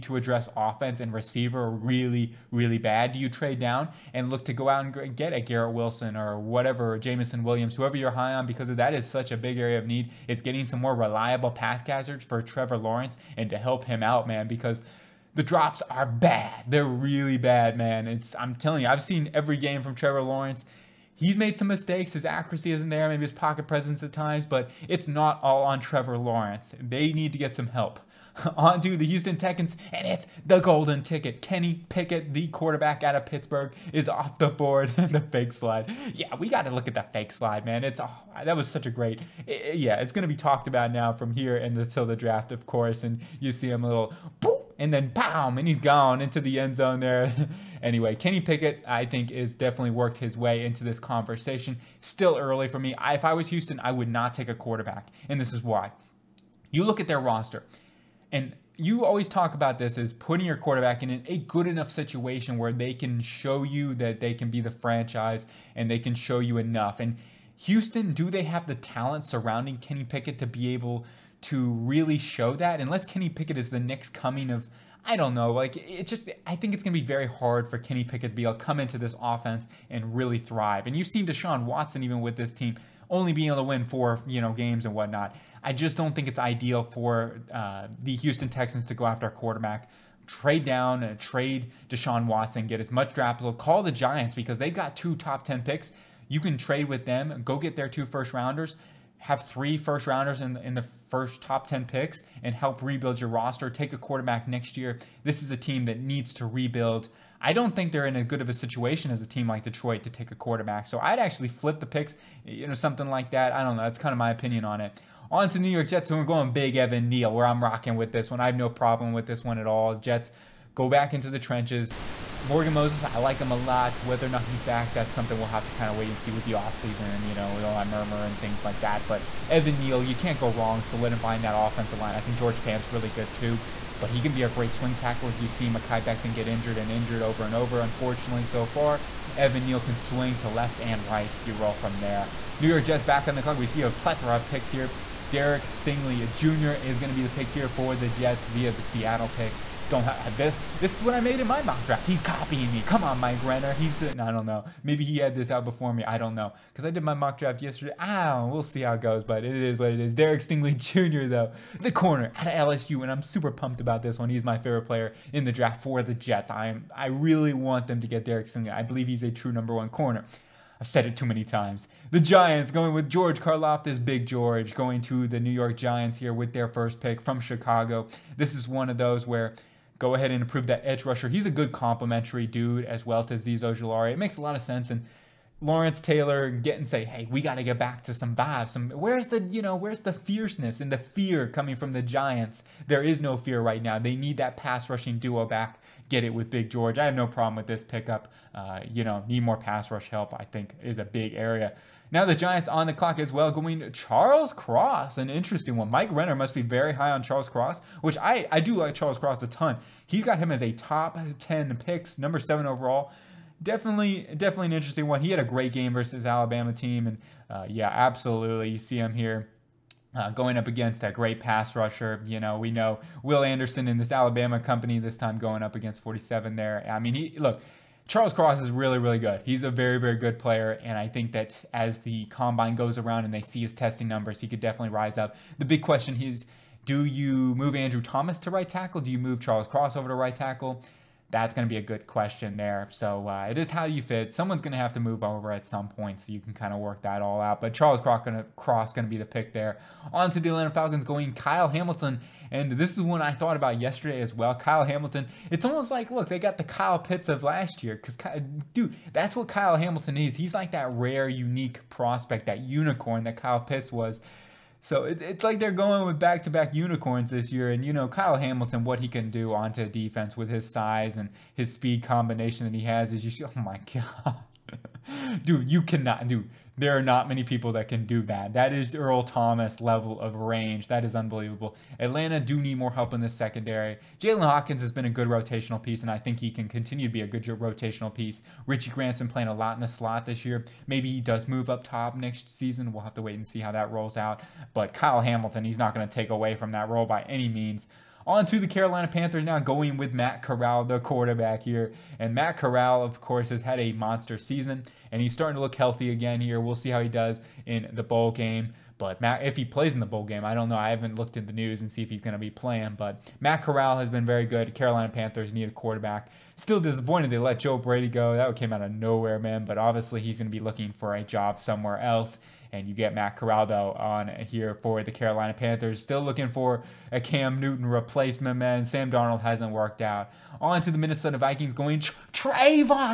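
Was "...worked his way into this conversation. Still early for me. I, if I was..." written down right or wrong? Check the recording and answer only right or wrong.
right.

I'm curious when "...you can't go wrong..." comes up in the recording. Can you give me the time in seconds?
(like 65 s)
130 s.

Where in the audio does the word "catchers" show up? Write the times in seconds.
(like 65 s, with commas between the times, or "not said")
11 s.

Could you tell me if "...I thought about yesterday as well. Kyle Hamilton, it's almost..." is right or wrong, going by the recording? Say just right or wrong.
right.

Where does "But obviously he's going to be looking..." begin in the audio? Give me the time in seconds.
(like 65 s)
319 s.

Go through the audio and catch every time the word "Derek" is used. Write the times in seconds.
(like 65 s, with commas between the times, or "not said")
145 s, 160 s, 168 s.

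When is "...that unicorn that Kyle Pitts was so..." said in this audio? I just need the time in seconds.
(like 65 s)
262 s.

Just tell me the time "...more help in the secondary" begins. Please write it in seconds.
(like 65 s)
282 s.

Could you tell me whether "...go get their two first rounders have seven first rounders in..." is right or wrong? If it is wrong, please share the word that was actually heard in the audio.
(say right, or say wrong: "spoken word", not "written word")
wrong: "three", not "seven".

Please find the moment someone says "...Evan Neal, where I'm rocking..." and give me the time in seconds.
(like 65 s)
116 s.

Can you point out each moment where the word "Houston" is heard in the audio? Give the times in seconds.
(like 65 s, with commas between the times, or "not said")
29 s, 53 s, 67 s, 88 s.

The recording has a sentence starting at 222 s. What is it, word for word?
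You know, we know Will Anderson in this Alabama company this time going up against 47 there.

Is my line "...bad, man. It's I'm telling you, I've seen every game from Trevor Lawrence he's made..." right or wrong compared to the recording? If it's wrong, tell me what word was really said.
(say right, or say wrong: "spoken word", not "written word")
right.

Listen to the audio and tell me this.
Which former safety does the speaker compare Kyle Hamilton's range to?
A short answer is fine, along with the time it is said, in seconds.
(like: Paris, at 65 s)
Earl Thomas, at 278 s.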